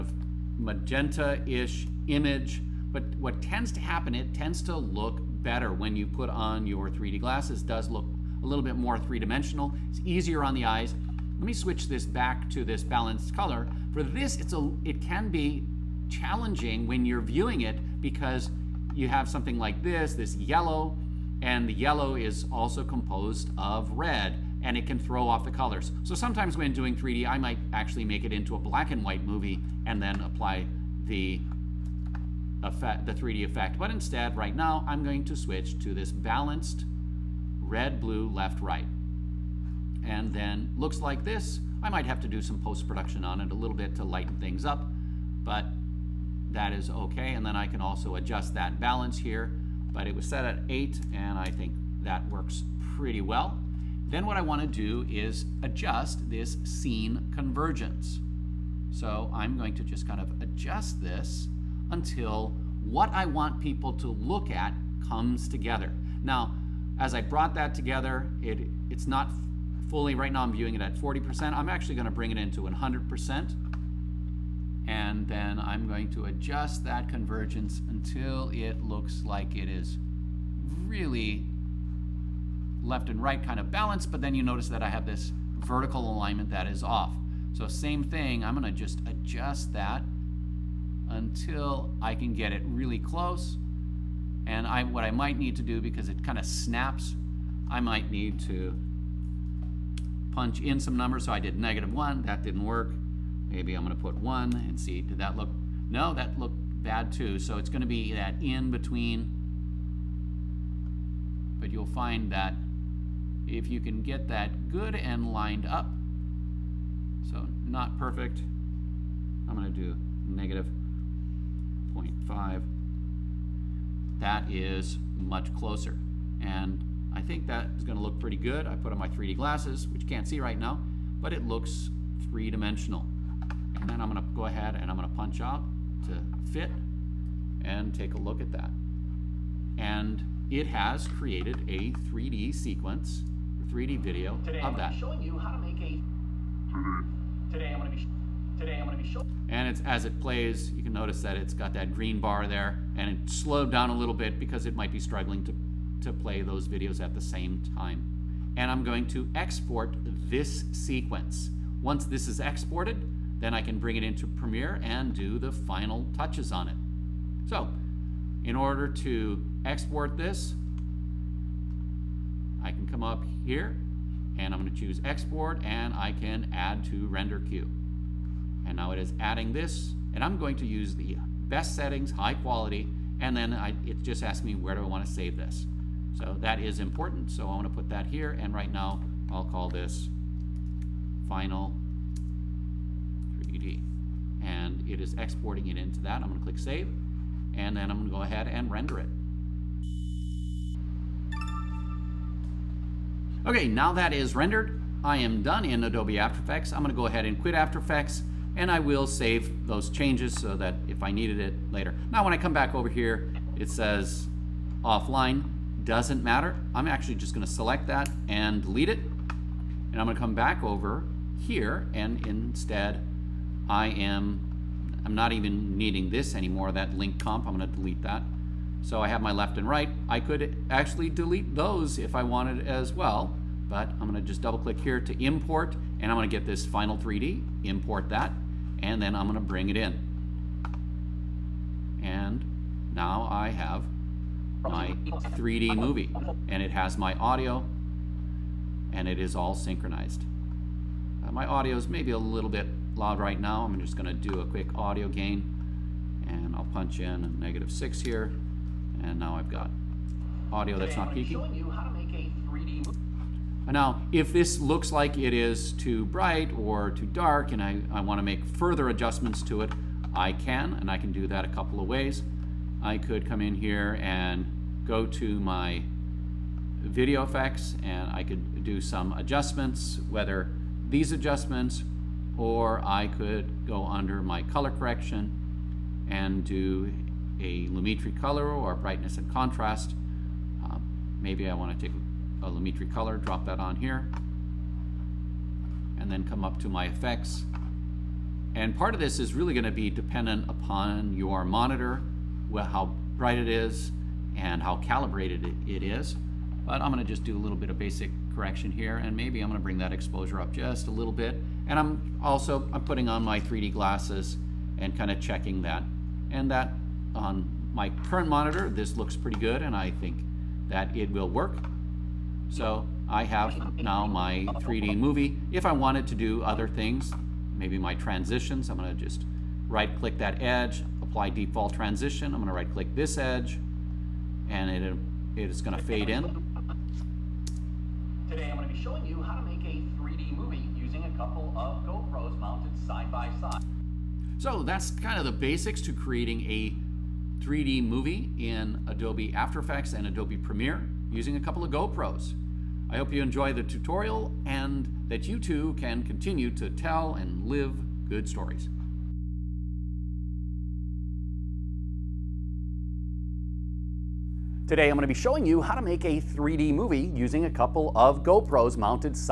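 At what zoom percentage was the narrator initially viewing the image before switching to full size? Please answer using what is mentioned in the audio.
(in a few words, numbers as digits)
40%.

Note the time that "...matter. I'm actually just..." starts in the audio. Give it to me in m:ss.
3:36.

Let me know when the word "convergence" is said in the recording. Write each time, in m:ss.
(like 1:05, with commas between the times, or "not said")
0:57, 1:17.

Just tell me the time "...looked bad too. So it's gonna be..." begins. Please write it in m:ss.
1:46.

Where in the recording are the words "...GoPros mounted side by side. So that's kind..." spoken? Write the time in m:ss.
5:41.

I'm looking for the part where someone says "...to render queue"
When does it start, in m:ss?
2:56.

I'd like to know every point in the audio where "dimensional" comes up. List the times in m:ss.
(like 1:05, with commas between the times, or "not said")
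0:08, 2:12.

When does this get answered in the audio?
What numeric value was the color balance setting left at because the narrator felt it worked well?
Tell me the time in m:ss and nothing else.
0:50.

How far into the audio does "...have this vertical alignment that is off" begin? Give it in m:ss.
1:24.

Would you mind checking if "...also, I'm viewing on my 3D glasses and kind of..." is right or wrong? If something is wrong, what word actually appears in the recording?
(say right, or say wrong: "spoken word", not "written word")
wrong: "putting", not "viewing".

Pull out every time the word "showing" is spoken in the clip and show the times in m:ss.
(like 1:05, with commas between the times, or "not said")
2:24, 2:29, 5:38, 6:05.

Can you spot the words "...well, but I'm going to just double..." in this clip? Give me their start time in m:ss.
3:52.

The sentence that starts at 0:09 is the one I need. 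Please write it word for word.
It's easier on the eyes, let me switch this back to this balanced color.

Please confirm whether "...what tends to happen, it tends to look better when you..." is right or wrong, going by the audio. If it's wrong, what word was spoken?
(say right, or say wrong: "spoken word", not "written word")
right.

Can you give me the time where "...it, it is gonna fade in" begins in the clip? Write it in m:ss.
5:34.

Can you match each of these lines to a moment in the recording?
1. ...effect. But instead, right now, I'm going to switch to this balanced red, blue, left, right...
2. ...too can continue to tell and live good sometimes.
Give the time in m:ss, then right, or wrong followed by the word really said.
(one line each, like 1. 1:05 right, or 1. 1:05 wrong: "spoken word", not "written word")
1. 0:33 right
2. 5:55 wrong: "stories", not "sometimes".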